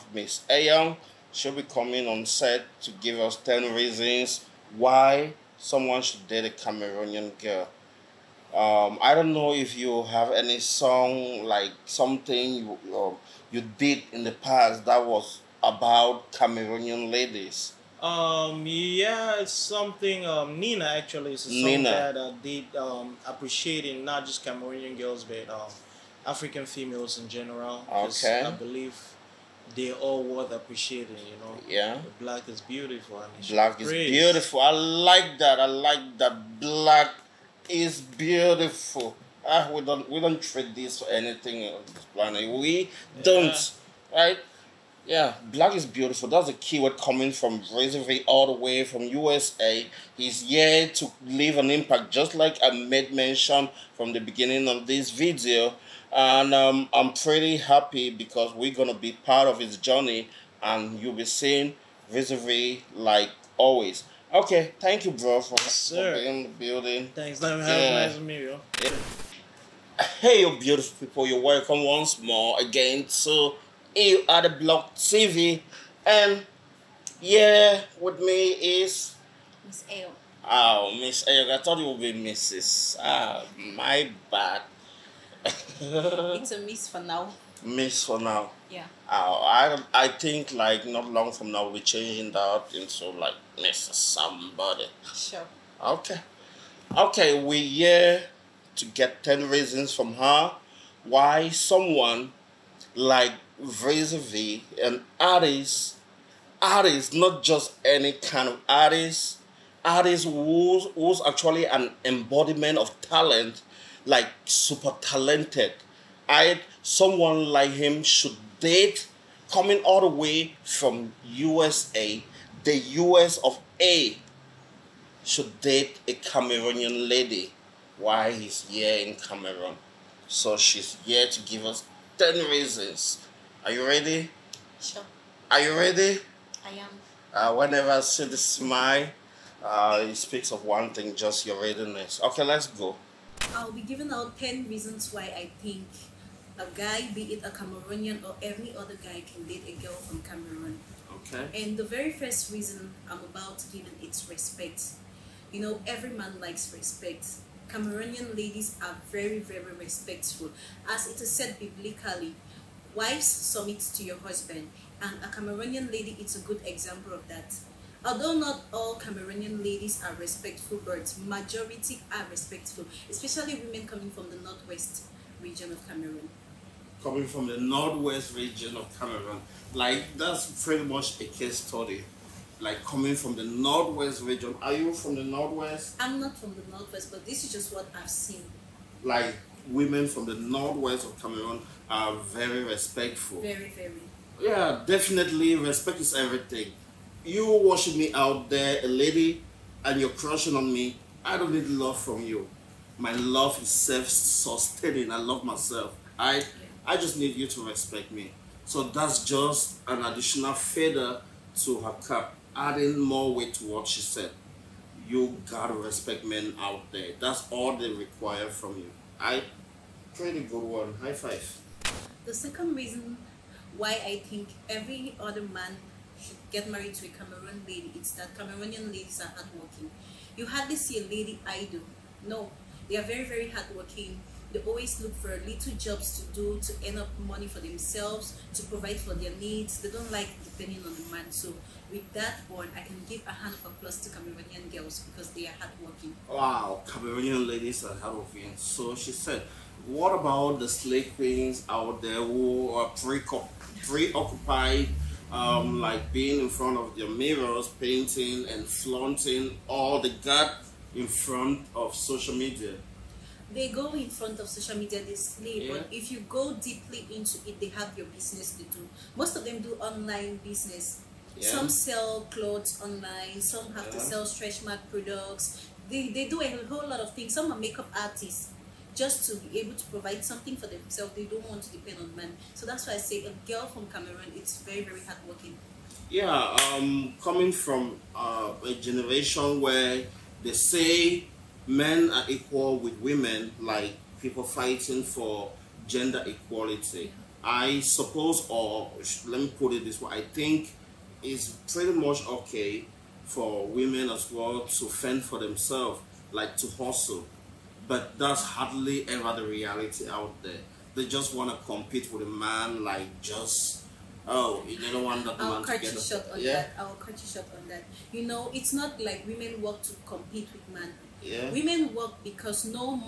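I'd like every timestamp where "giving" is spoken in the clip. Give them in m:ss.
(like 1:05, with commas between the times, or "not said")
2:23, 2:33.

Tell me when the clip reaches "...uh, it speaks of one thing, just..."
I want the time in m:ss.
2:19.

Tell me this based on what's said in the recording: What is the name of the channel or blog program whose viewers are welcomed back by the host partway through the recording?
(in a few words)
Iyunade Blog TV.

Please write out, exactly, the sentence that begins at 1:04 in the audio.
Okay, thank you, bro, for, for being in the building.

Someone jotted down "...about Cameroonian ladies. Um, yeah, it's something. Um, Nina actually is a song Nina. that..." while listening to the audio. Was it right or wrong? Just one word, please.
right.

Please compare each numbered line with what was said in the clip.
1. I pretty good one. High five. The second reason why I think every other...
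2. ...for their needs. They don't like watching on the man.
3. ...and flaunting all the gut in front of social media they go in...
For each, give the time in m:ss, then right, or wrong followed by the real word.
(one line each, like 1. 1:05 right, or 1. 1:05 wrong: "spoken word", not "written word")
1. 3:39 right
2. 3:58 wrong: "depending", not "watching"
3. 4:18 right.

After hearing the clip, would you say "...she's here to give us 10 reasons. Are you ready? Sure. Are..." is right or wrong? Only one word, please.
right.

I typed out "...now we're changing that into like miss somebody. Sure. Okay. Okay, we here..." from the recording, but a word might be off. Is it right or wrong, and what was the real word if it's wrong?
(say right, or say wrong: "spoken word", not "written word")
right.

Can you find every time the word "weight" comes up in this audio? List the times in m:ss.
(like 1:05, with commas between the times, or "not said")
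3:33.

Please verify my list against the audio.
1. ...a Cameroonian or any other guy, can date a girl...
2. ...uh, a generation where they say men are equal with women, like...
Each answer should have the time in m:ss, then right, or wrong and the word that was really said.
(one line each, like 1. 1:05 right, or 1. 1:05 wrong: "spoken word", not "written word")
1. 2:27 right
2. 4:48 right.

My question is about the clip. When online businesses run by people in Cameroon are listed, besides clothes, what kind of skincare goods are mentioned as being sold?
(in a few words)
Stretch mark products.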